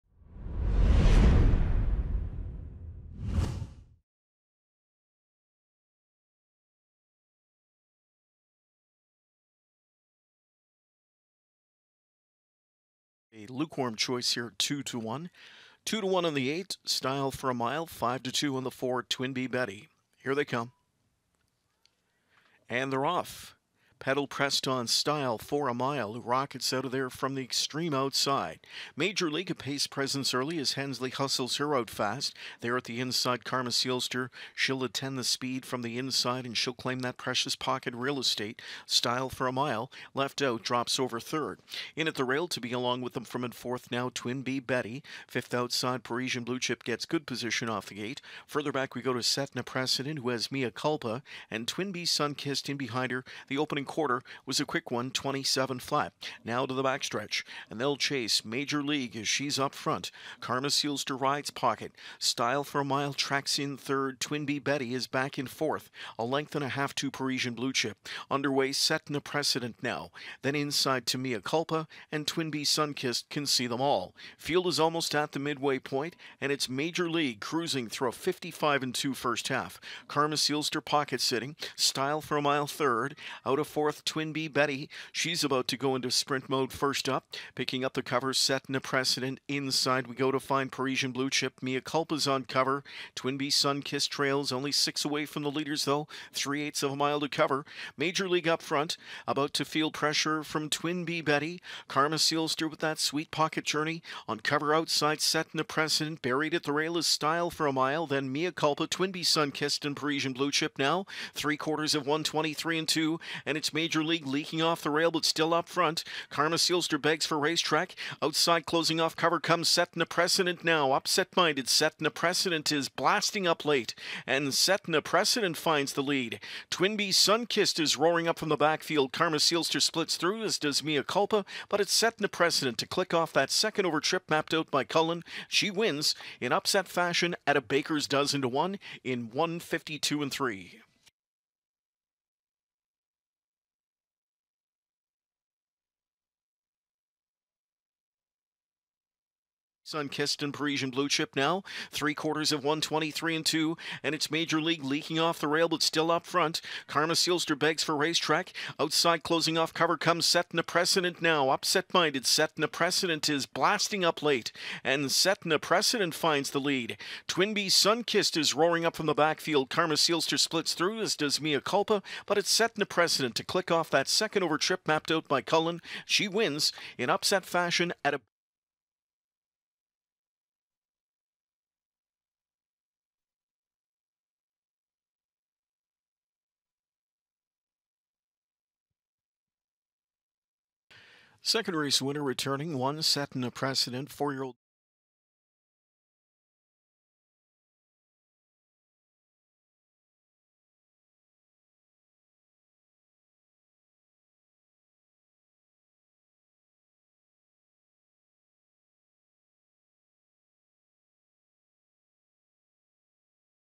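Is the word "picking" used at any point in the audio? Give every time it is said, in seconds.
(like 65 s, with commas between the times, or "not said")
87 s.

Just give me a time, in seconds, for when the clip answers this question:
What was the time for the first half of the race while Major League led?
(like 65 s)
78 s.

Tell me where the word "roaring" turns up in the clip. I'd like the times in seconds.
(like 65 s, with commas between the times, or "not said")
127 s, 168 s.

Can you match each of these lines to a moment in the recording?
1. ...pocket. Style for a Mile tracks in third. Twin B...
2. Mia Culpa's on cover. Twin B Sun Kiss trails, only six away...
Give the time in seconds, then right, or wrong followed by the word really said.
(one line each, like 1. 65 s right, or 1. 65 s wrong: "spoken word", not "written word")
1. 61 s right
2. 91 s right.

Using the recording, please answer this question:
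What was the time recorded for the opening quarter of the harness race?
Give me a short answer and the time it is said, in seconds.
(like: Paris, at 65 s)
27 flat, at 55 s.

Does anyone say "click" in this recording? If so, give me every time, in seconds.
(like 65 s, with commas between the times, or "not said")
132 s, 173 s.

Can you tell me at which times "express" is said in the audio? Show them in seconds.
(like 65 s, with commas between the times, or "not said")
not said.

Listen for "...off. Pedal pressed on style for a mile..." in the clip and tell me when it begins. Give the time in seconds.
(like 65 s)
23 s.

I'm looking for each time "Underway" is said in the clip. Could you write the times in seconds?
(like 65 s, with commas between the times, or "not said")
68 s.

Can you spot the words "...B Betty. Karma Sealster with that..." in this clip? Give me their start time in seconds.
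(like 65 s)
101 s.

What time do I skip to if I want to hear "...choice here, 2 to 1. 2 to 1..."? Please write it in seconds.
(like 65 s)
13 s.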